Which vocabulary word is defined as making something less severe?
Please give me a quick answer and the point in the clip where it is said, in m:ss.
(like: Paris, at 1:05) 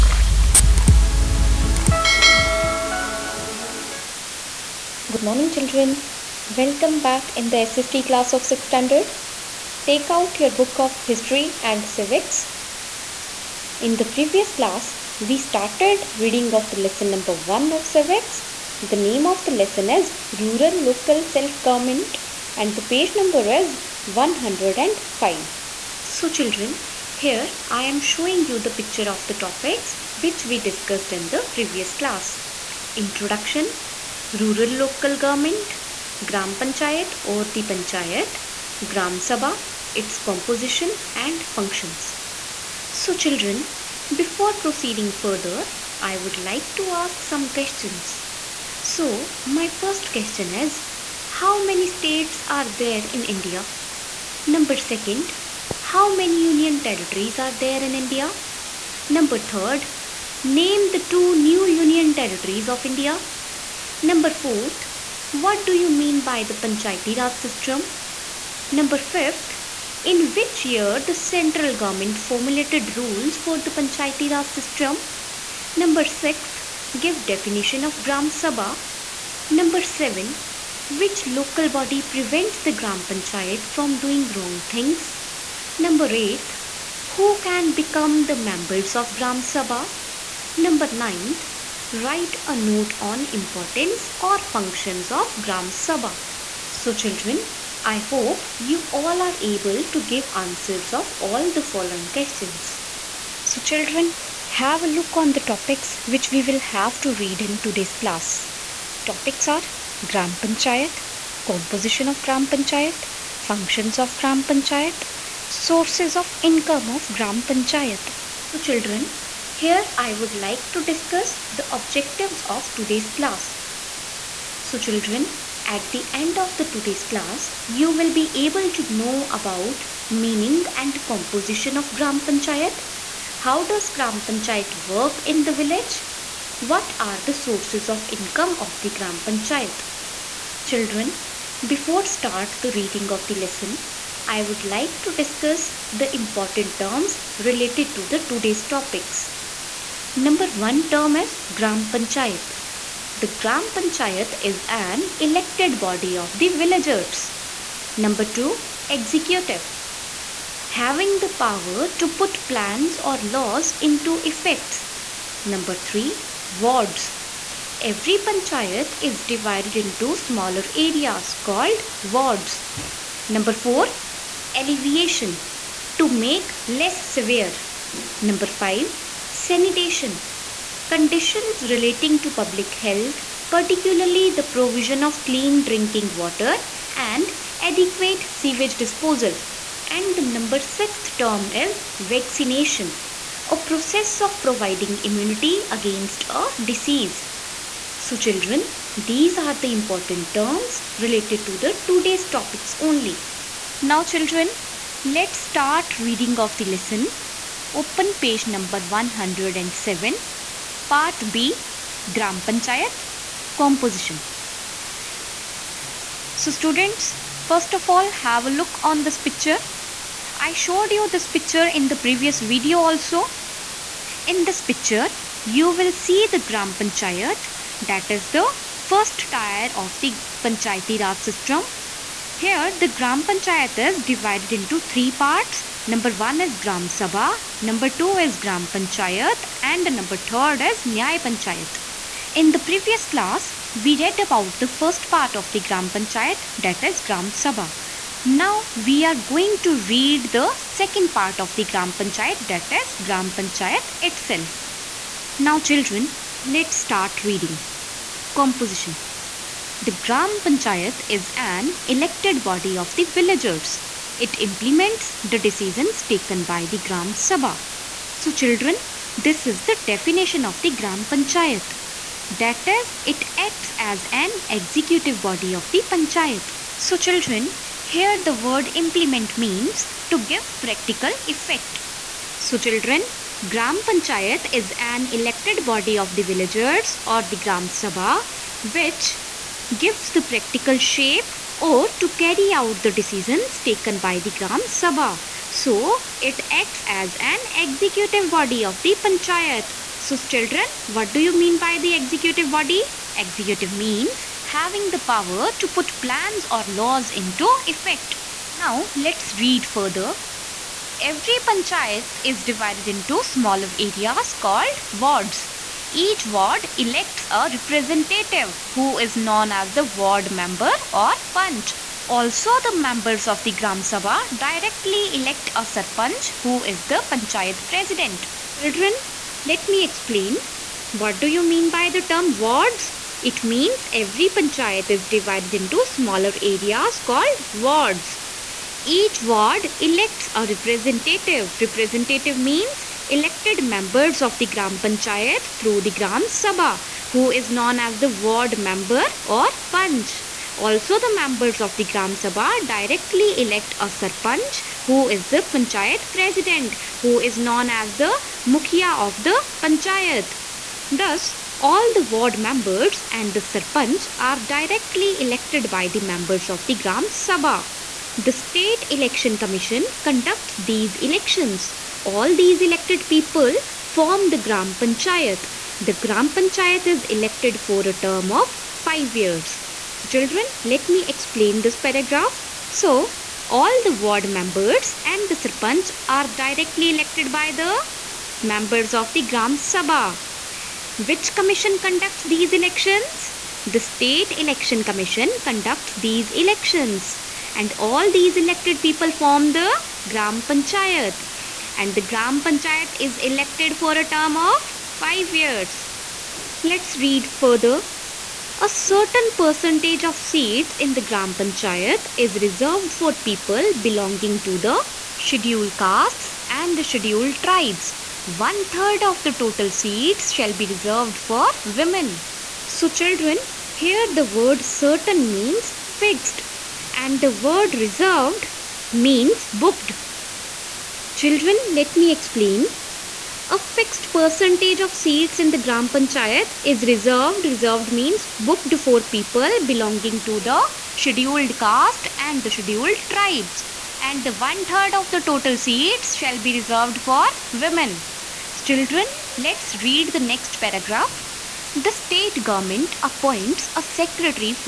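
Alleviation, at 2:54.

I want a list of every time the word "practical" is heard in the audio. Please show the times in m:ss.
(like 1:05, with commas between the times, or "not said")
4:40, 4:50.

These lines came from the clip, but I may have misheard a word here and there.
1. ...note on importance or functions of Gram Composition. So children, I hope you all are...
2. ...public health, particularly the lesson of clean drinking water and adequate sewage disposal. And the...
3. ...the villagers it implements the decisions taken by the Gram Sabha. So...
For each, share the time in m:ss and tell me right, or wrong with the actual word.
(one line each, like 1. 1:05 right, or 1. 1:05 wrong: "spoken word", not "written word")
1. 1:32 wrong: "Sabha", not "Composition"
2. 3:02 wrong: "provision", not "lesson"
3. 4:22 right.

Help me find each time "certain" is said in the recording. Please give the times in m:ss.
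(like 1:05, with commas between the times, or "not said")
6:48, 7:04.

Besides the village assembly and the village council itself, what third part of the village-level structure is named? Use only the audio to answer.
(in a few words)
Nyay Panchayat.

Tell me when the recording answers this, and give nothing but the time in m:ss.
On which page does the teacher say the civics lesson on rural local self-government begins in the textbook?
0:22.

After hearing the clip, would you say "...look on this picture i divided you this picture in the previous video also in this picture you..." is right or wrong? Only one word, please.
wrong.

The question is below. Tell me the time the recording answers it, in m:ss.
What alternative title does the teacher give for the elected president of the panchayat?
5:58.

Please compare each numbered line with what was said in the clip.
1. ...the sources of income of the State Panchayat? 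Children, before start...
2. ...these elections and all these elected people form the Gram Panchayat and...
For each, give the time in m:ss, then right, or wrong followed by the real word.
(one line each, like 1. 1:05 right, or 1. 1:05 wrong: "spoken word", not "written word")
1. 2:17 wrong: "Gram", not "State"
2. 6:35 right.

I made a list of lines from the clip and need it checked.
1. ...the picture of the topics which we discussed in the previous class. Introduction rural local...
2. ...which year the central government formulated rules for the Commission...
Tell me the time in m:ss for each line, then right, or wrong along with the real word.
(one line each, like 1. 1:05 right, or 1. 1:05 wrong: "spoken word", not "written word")
1. 0:28 right
2. 1:10 wrong: "Panchayati", not "Commission".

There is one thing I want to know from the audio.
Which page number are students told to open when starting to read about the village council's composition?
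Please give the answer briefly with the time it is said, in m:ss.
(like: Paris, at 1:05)
107, at 3:28.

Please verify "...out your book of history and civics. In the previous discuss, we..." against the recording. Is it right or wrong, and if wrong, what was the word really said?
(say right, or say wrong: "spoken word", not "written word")
wrong: "class", not "discuss".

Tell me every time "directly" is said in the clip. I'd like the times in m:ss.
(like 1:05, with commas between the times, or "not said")
5:24, 5:52, 6:04, 6:26.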